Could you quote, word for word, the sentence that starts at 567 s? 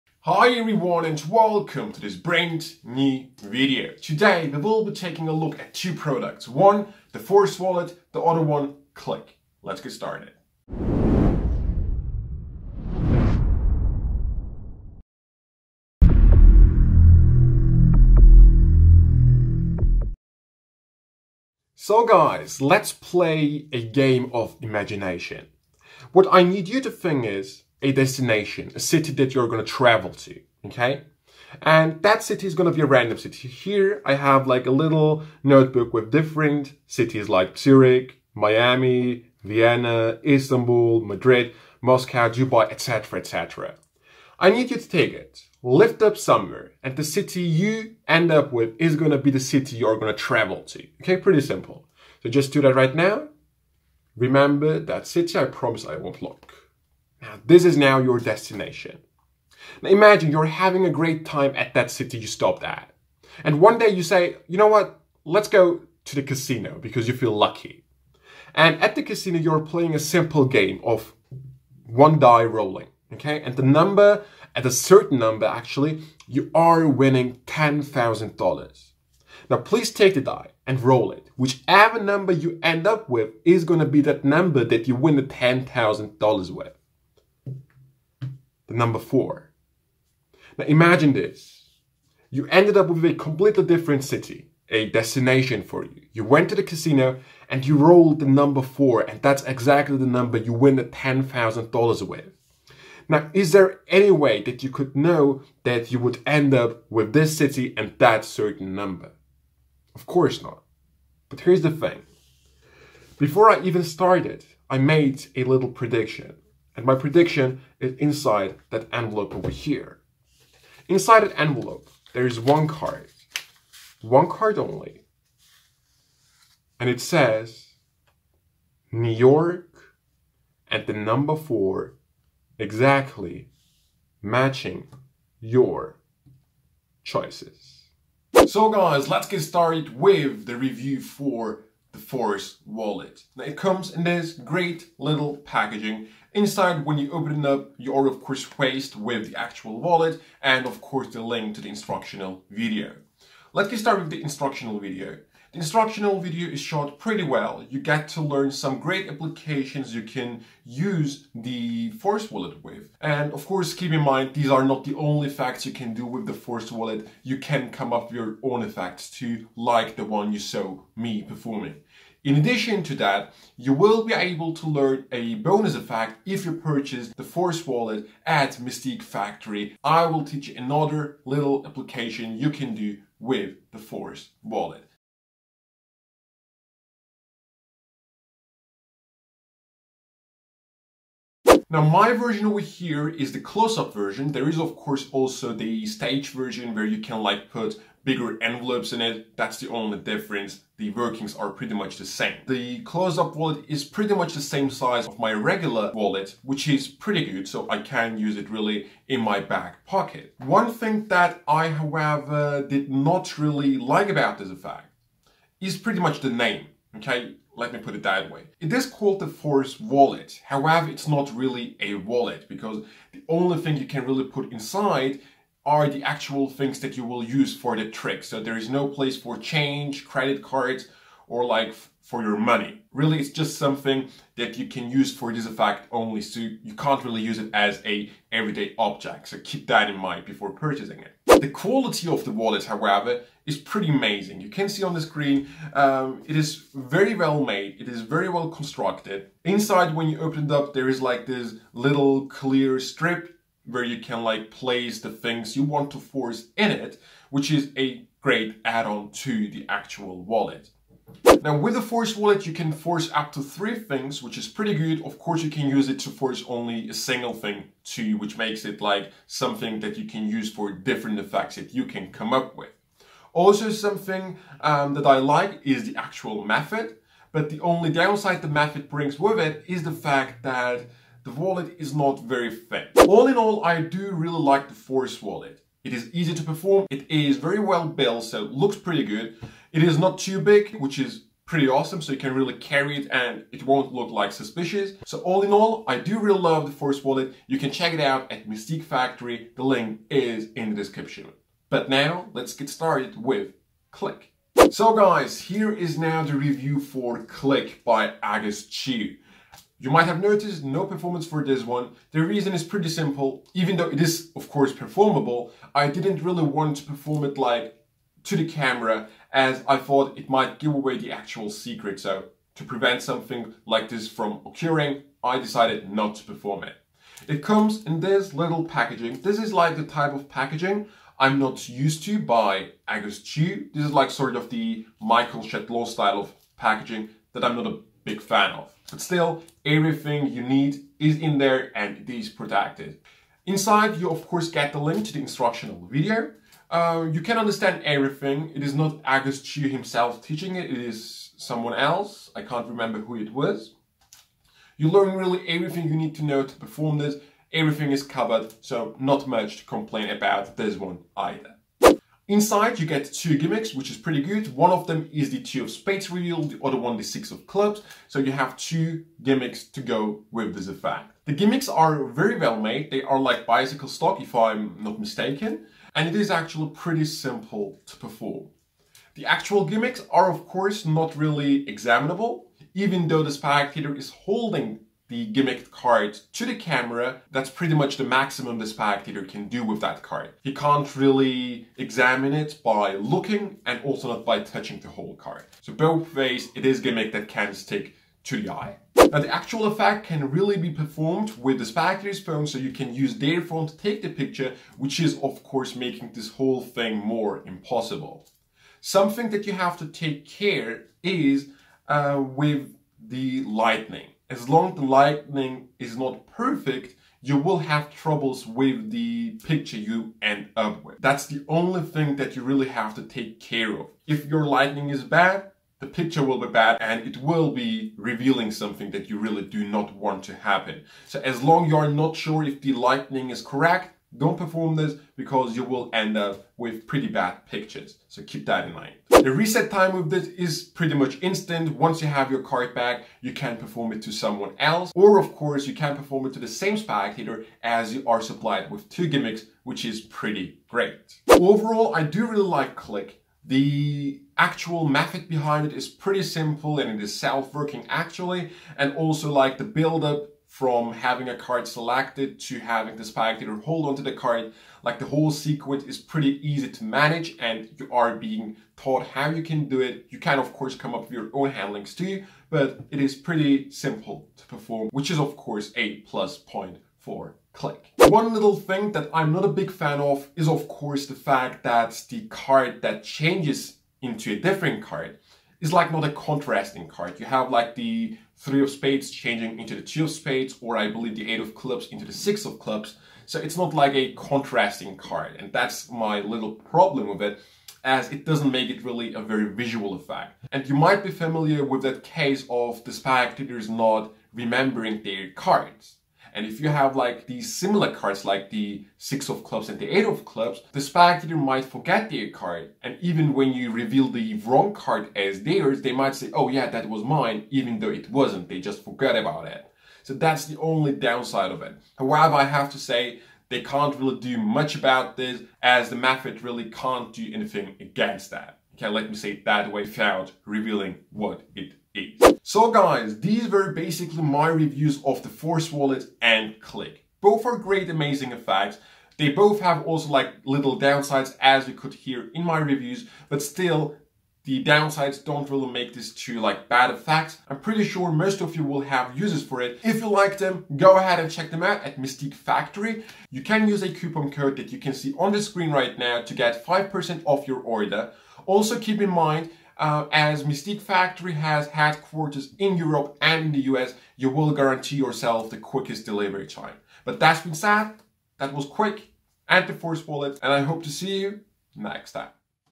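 But that's been said, that was quick, and the Force Wallet, and I hope to see you next time.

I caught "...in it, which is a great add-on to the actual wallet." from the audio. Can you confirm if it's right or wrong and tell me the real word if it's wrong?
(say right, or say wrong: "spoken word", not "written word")
right.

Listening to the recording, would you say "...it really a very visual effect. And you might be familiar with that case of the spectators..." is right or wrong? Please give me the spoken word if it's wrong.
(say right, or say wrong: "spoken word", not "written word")
right.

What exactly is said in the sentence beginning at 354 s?
You learn really everything you need to know to perform this.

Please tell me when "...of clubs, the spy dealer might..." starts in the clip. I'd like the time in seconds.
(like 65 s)
510 s.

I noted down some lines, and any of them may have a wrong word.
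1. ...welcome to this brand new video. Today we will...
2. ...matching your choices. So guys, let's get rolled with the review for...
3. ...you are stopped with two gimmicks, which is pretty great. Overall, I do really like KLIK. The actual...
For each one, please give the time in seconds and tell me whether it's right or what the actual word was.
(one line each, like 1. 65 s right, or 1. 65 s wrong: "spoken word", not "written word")
1. 1 s right
2. 134 s wrong: "started", not "rolled"
3. 447 s wrong: "supplied", not "stopped".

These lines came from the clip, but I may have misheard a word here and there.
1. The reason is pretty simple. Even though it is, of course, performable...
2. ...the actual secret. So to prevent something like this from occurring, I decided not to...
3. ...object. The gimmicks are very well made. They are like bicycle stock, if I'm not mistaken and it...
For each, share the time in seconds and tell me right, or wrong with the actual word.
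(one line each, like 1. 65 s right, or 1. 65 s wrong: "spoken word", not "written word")
1. 312 s right
2. 320 s right
3. 370 s wrong: "effect", not "object".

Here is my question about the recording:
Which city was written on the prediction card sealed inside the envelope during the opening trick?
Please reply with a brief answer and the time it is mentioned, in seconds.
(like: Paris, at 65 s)
New York, at 128 s.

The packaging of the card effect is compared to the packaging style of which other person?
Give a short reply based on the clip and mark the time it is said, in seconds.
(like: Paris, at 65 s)
Michael Shetlaw, at 334 s.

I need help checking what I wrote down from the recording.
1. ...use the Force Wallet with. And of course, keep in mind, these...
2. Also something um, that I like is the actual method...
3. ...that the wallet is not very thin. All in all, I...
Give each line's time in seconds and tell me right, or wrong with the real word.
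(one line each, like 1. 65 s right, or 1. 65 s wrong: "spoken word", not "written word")
1. 160 s right
2. 273 s right
3. 280 s right.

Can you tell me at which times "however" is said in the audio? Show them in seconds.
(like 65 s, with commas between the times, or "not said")
211 s, 220 s, 242 s, 521 s.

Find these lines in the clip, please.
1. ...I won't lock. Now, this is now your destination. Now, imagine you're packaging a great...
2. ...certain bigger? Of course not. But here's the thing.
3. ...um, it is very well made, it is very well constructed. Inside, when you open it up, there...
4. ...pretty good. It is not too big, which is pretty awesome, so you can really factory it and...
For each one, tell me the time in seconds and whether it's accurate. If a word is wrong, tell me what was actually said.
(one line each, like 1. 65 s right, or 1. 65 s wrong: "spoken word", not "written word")
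1. 55 s wrong: "having", not "packaging"
2. 108 s wrong: "number", not "bigger"
3. 245 s right
4. 288 s wrong: "carry", not "factory".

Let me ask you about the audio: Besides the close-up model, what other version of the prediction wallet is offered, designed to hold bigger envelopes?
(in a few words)
stage version.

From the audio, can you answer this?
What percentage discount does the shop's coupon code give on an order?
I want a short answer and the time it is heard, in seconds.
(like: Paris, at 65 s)
5%, at 556 s.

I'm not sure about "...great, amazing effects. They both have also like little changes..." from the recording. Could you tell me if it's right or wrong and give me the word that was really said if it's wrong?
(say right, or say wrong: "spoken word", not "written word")
wrong: "downsides", not "changes".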